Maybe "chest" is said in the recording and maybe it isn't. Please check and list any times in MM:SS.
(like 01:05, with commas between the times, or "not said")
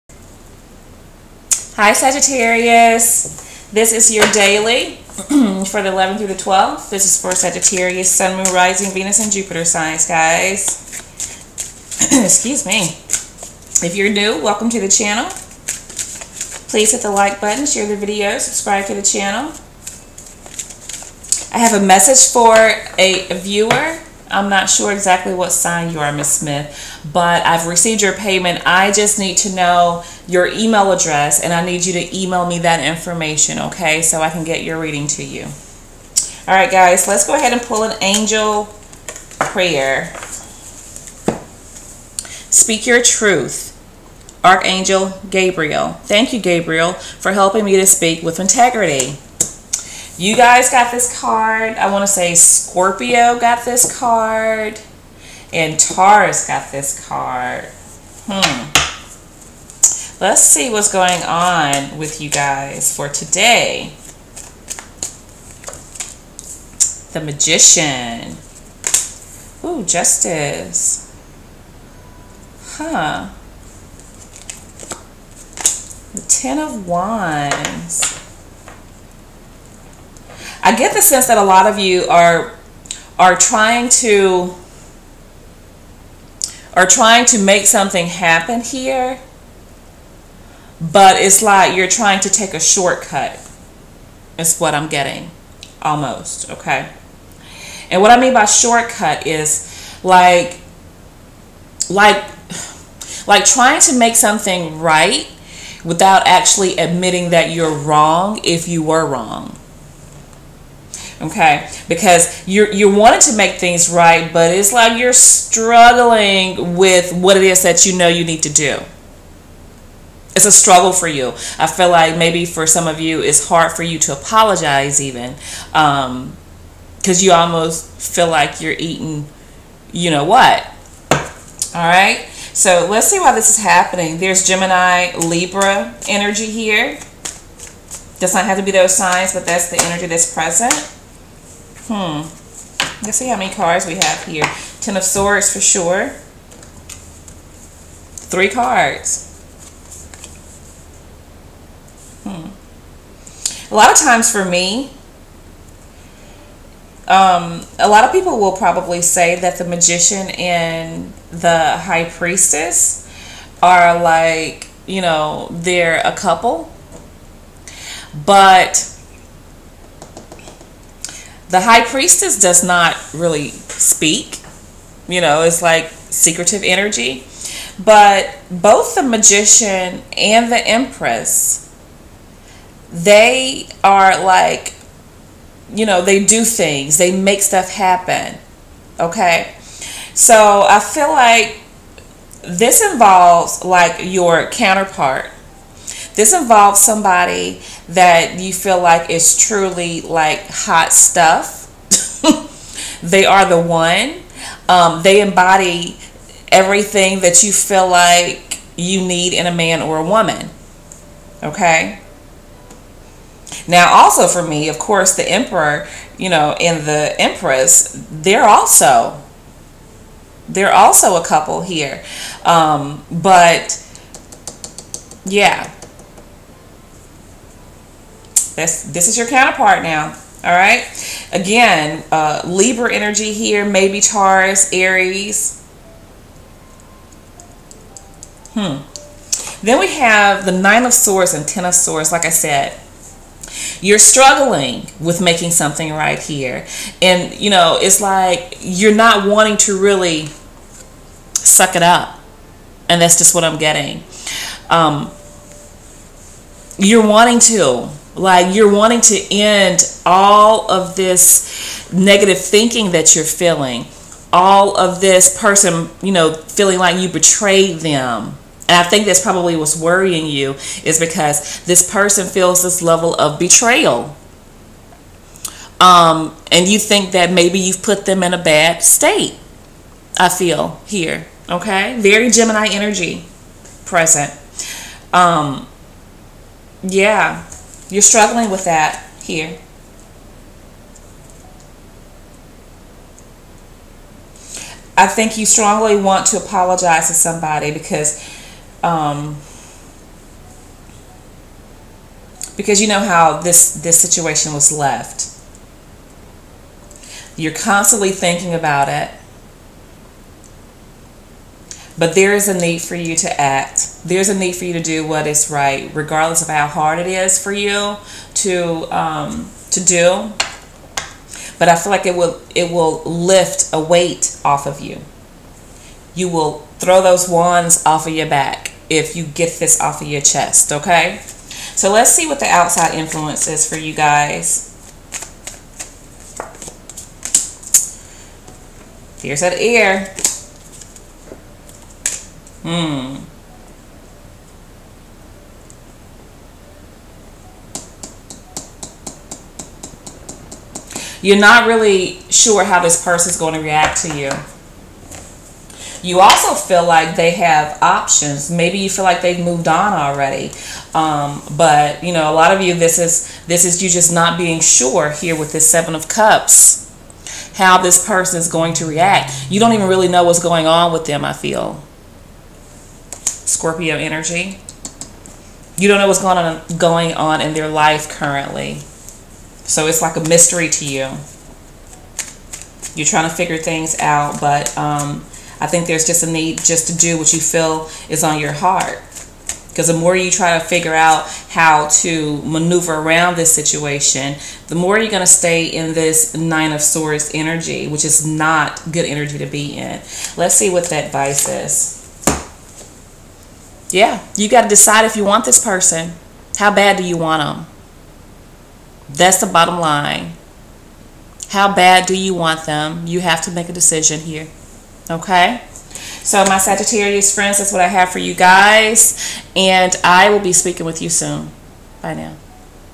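05:30.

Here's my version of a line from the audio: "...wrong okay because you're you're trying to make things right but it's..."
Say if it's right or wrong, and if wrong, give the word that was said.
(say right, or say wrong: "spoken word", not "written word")
wrong: "wanting", not "trying".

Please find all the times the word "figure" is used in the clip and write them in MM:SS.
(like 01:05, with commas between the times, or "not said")
06:23, 06:30.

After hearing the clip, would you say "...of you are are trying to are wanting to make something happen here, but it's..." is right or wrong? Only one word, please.
wrong.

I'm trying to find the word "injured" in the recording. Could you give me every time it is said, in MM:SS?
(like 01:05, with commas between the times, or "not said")
not said.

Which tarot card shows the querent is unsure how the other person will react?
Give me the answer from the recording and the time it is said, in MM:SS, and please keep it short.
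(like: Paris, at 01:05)
Seven of Cups, at 06:05.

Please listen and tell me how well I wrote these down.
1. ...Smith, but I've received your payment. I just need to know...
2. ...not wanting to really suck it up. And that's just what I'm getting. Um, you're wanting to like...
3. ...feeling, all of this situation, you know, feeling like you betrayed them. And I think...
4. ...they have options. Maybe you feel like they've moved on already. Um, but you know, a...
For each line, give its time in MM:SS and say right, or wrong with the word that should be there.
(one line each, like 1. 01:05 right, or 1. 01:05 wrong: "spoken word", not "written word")
1. 00:26 right
2. 04:08 right
3. 04:23 wrong: "person", not "situation"
4. 05:57 right.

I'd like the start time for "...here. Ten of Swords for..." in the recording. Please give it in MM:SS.
02:24.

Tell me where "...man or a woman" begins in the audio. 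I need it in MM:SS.
03:29.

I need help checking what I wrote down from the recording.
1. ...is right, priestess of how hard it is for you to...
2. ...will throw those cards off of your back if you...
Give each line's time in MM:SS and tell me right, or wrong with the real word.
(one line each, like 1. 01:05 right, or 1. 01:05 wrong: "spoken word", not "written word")
1. 05:15 wrong: "regardless", not "priestess"
2. 05:26 wrong: "wands", not "cards".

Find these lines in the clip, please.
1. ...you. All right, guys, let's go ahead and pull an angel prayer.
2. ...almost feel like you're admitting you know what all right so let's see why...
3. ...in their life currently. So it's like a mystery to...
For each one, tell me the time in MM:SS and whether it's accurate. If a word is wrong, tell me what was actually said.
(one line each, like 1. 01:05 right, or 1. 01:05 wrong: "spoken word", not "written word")
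1. 00:35 right
2. 02:07 wrong: "eating", not "admitting"
3. 06:17 right.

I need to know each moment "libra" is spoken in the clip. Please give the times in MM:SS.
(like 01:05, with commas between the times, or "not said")
02:15, 03:52.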